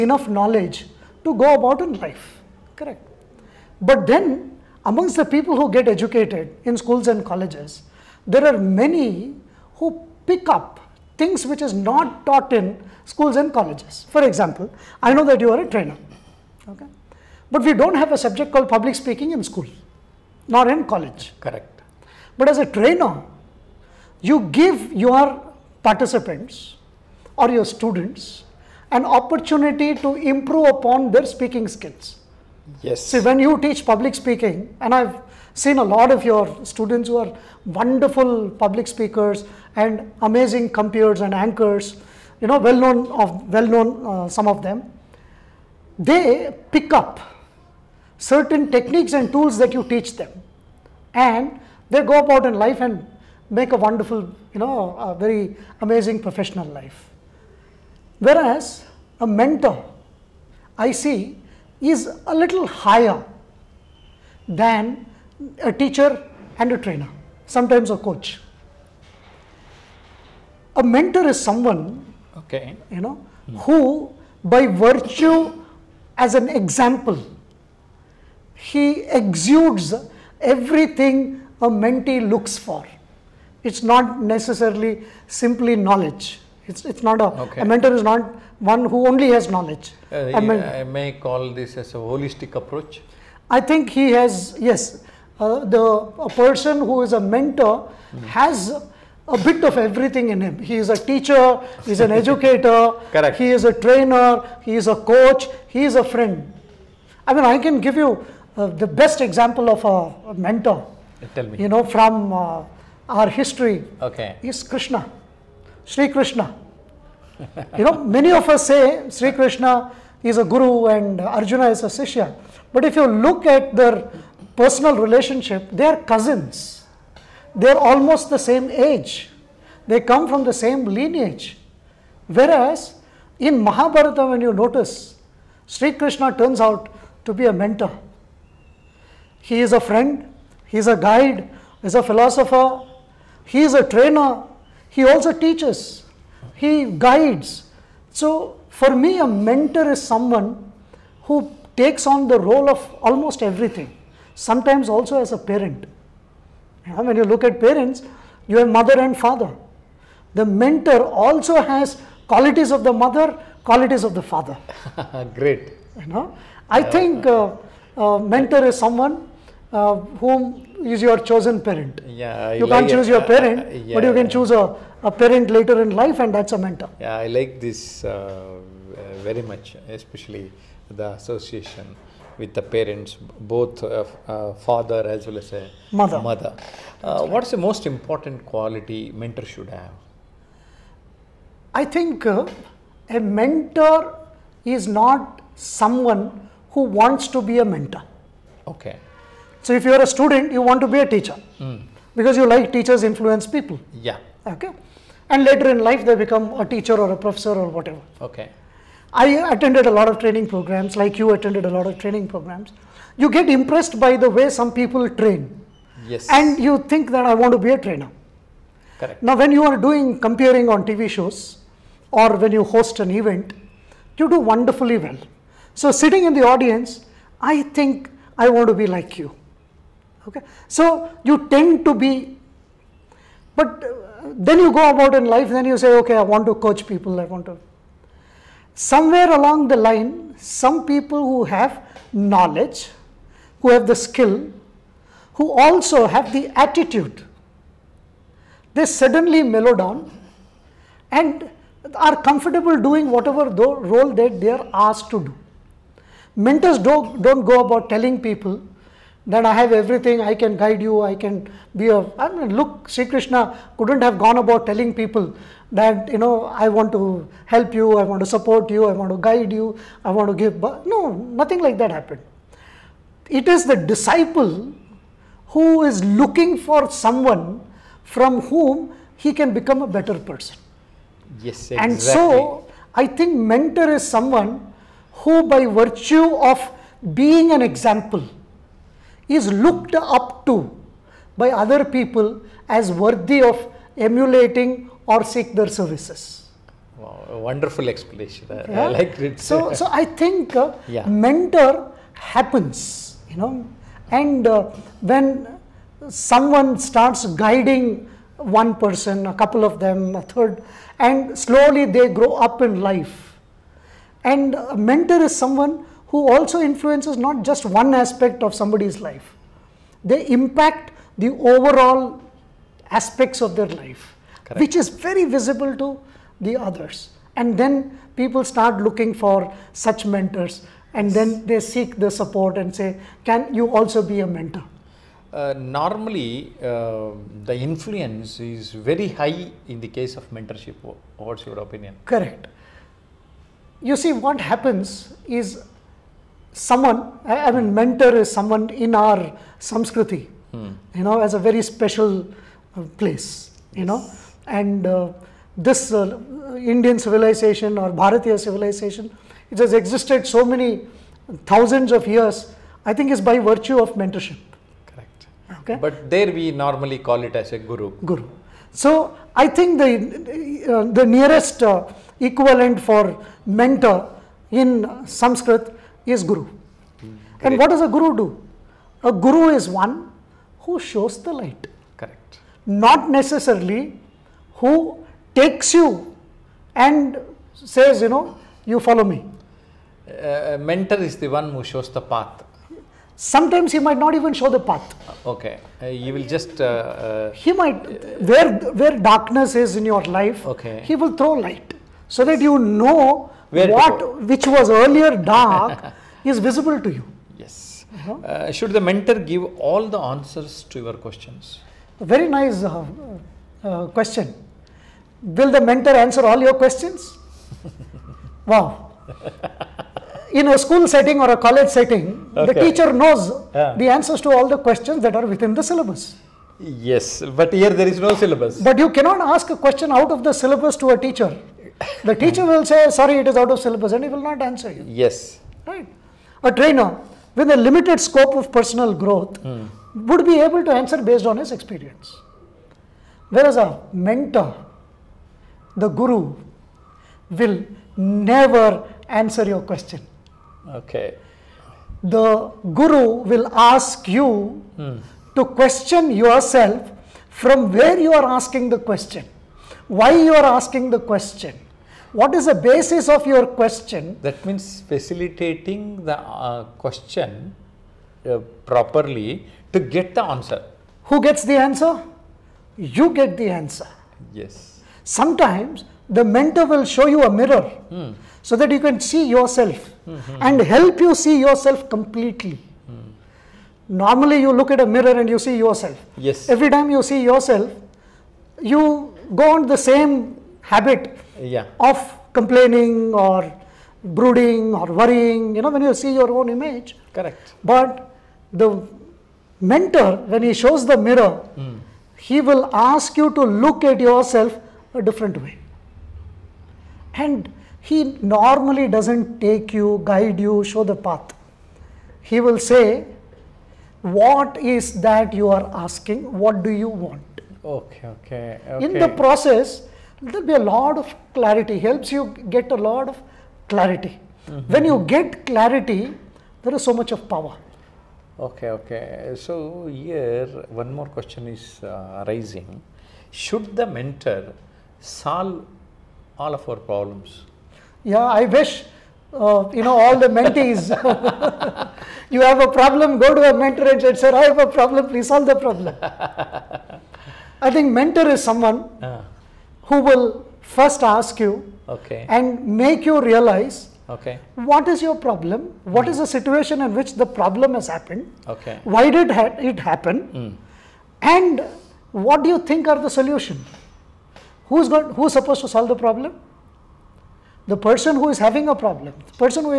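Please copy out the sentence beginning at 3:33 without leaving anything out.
You get impressed by the way some people train.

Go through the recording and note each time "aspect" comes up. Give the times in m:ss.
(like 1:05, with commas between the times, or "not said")
5:17, 5:22.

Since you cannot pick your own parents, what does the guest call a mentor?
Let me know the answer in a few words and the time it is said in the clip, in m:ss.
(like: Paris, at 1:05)
Your chosen parent, at 2:51.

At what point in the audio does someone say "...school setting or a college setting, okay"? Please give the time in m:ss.
7:00.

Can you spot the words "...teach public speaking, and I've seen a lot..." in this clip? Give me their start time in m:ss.
0:33.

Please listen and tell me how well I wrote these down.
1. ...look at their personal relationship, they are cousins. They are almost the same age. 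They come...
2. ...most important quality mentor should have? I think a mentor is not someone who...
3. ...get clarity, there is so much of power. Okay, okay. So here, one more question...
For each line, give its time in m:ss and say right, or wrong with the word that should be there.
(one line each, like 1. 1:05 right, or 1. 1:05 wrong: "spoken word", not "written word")
1. 2:03 right
2. 3:07 right
3. 8:45 right.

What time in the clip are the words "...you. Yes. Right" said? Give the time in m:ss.
7:14.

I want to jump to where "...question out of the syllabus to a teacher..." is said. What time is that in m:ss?
7:09.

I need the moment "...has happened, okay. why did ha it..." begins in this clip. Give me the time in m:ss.
9:17.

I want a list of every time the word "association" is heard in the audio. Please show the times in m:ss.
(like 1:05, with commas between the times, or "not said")
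3:01.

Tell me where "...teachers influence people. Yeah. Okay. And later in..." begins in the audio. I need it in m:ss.
3:22.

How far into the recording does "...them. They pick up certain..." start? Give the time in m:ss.
0:44.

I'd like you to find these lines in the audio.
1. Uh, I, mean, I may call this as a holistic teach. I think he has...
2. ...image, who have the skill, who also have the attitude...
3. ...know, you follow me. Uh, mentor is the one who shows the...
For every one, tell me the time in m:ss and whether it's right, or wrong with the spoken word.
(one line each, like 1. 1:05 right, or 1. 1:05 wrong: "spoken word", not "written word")
1. 1:30 wrong: "approach", not "teach"
2. 4:02 wrong: "knowledge", not "image"
3. 6:28 right.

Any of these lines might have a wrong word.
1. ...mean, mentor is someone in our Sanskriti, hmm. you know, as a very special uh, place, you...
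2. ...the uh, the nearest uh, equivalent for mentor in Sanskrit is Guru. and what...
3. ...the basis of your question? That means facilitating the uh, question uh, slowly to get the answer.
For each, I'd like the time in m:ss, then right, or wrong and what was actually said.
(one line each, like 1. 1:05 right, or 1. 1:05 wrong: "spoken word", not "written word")
1. 5:47 right
2. 6:09 right
3. 7:42 wrong: "properly", not "slowly".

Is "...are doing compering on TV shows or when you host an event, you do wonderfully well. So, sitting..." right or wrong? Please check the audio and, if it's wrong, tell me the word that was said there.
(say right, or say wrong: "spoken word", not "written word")
right.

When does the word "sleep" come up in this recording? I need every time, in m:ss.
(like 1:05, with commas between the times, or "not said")
not said.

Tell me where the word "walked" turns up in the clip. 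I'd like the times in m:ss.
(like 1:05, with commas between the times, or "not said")
not said.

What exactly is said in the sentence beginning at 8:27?
And he normally doesn't take you, guide you, show the path.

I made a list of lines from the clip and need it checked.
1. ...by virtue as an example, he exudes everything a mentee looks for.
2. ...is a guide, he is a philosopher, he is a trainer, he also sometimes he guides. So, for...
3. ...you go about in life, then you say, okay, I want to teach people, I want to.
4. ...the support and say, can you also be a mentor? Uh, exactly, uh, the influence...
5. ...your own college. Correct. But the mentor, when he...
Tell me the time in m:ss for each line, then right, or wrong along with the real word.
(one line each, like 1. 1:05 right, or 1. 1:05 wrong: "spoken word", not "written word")
1. 1:14 right
2. 2:20 wrong: "teaches", not "sometimes"
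3. 3:54 wrong: "coach", not "teach"
4. 5:31 wrong: "normally", not "exactly"
5. 8:16 wrong: "image", not "college".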